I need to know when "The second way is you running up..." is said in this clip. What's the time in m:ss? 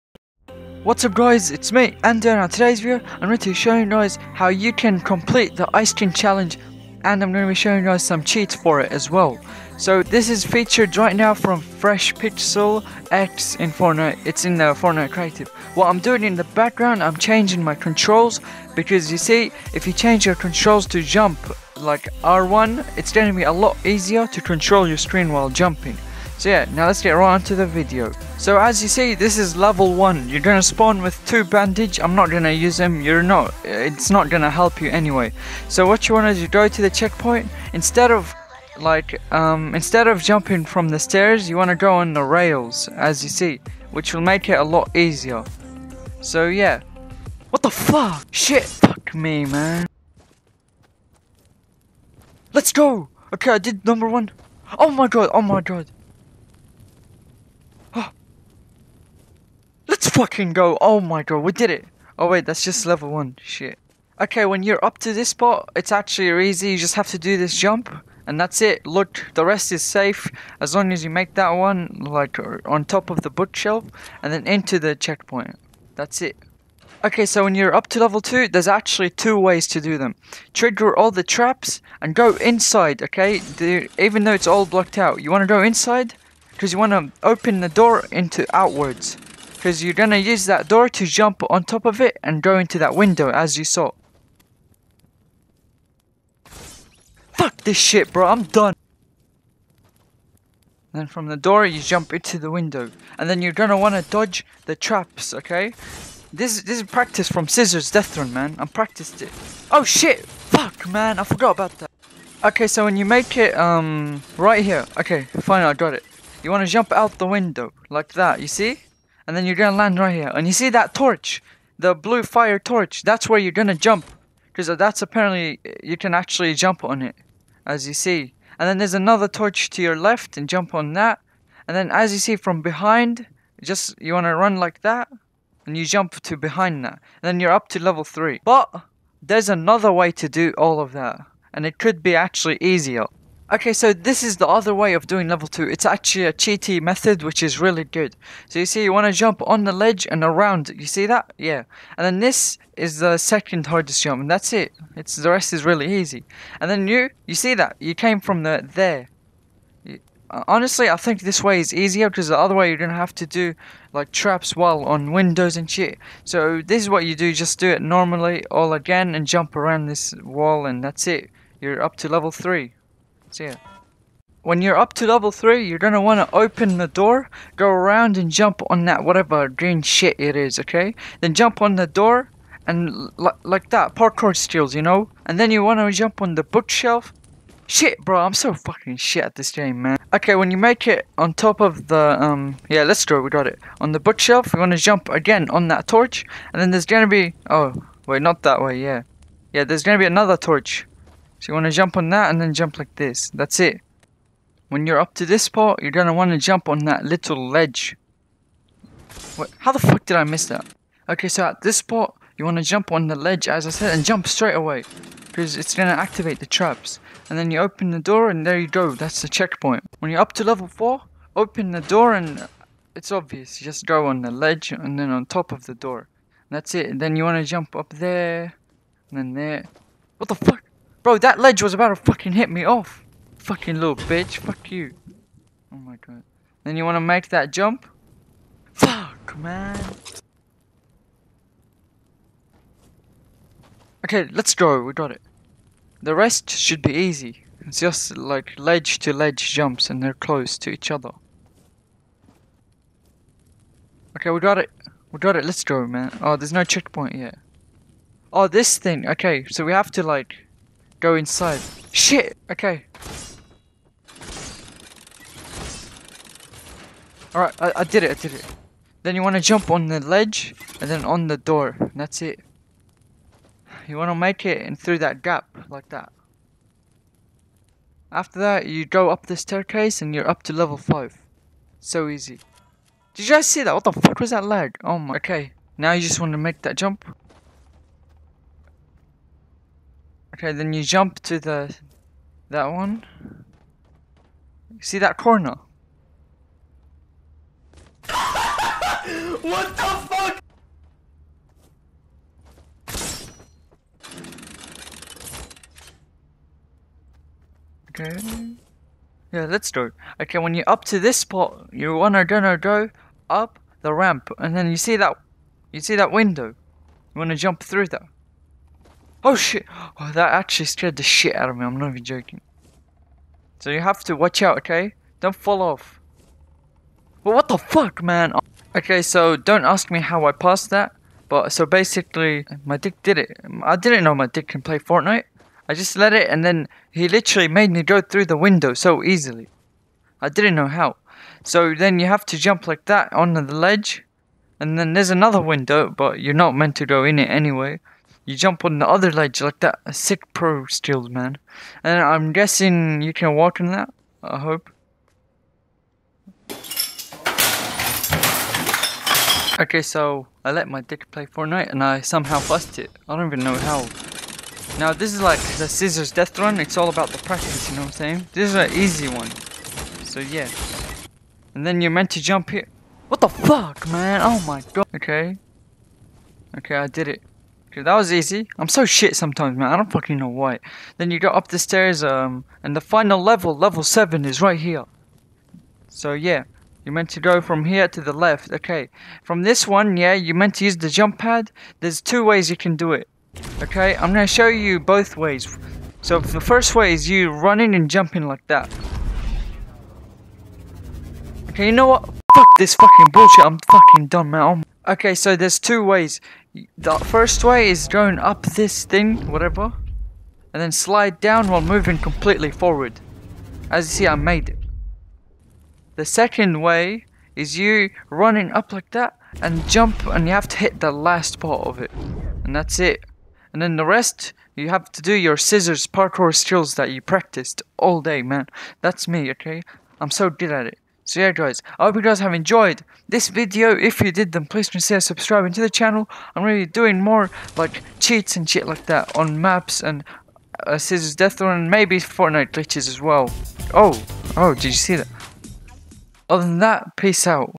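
6:55.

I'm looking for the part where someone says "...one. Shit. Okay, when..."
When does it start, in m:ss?
1:03.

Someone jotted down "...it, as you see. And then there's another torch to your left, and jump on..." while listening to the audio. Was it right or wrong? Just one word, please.
right.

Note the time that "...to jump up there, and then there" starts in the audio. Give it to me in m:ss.
3:47.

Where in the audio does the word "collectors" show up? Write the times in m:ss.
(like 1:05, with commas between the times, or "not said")
not said.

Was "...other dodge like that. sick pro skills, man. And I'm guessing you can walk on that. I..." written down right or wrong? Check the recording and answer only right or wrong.
wrong.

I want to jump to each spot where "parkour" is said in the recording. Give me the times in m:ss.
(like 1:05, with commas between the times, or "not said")
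3:03, 7:05.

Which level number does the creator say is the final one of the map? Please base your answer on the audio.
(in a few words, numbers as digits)
7.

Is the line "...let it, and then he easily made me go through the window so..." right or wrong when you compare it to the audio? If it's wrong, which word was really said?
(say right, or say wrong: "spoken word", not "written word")
wrong: "literally", not "easily".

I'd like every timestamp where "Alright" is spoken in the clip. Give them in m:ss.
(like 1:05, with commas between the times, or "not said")
4:27.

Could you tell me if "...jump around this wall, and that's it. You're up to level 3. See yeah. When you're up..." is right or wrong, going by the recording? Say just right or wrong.
right.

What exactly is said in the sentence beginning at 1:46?
This, this is practice from Cizzorz Death Run man, I practiced it.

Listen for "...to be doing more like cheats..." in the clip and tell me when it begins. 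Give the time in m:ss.
7:16.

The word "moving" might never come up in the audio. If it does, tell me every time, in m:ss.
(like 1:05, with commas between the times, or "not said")
6:51.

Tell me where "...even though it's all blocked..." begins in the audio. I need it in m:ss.
1:23.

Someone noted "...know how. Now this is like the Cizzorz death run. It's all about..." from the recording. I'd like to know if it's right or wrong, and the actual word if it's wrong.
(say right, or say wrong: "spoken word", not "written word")
right.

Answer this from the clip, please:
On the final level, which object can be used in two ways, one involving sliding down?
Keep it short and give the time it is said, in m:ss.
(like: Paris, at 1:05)
jump pad, at 6:30.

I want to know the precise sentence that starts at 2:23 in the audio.
Okay, so this is the other way of doing level 2.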